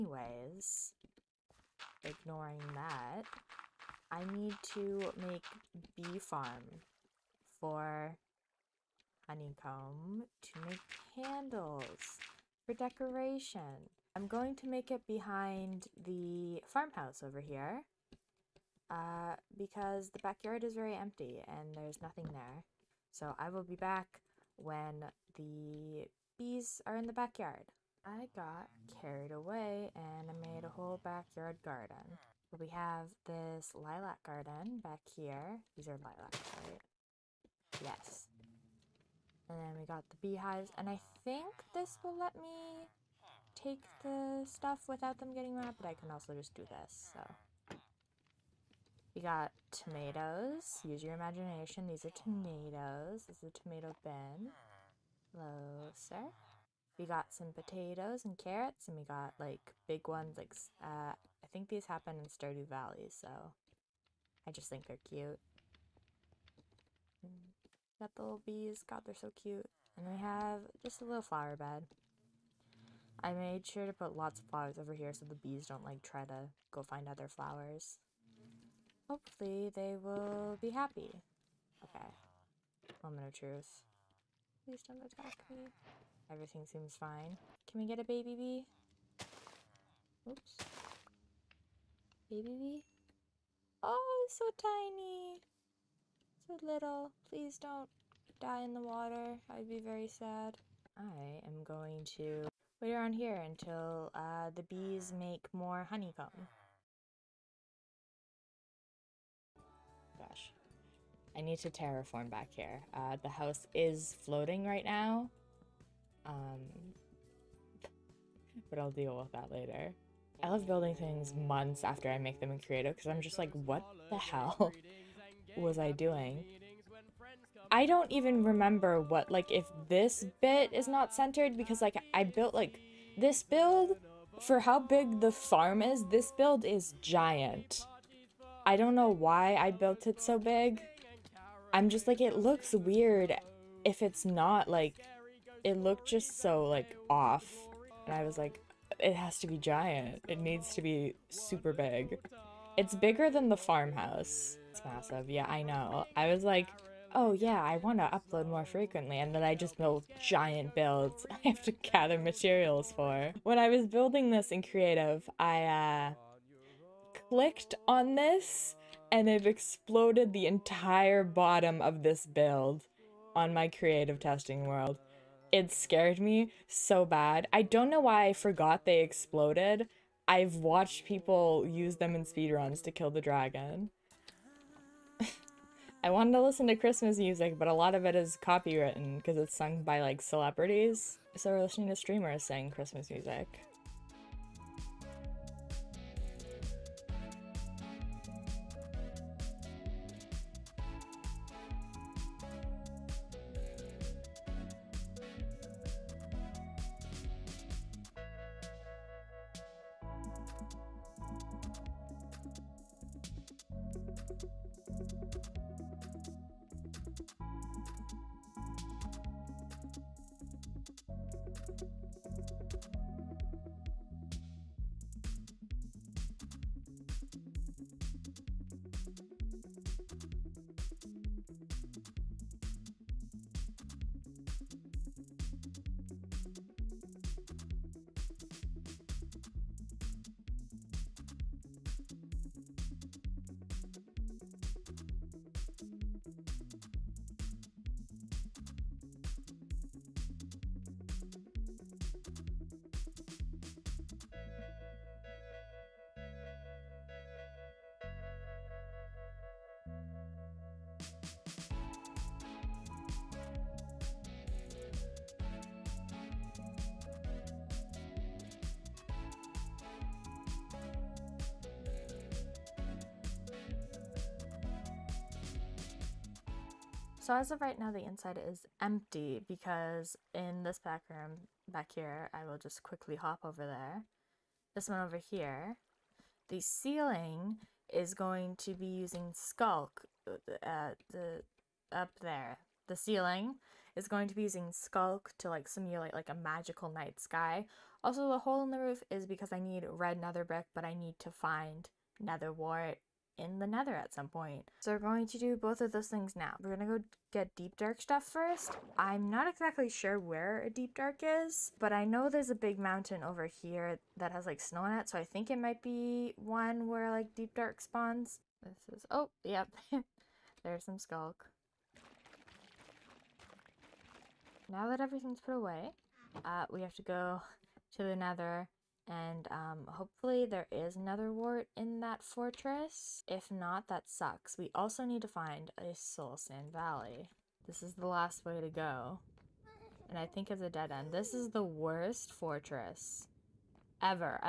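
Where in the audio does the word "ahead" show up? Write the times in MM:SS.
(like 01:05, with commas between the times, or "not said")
not said.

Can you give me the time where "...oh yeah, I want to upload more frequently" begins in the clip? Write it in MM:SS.
02:37.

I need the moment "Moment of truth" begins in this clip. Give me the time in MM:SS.
01:23.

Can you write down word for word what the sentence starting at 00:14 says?
I'm going to make it behind the farmhouse over here uh, because the backyard is very empty and there's nothing there.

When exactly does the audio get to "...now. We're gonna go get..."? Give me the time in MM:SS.
05:06.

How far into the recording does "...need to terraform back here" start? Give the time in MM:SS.
01:51.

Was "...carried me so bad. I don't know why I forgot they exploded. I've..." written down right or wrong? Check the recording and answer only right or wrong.
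wrong.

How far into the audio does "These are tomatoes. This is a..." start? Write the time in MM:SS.
00:51.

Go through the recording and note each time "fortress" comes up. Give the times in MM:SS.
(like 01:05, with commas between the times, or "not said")
05:32, 05:42.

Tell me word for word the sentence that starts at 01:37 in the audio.
Please don't die in the water.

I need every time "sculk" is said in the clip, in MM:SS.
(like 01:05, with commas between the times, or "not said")
04:49, 04:54, 05:20.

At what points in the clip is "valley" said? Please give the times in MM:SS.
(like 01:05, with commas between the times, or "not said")
01:02, 05:36.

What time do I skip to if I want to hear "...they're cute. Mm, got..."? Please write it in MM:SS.
01:04.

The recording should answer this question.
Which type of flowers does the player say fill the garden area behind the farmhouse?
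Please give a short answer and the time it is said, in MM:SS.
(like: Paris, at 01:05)
Lilacs, at 00:35.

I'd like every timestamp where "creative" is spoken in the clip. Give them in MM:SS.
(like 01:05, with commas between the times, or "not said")
02:02, 02:44, 02:53.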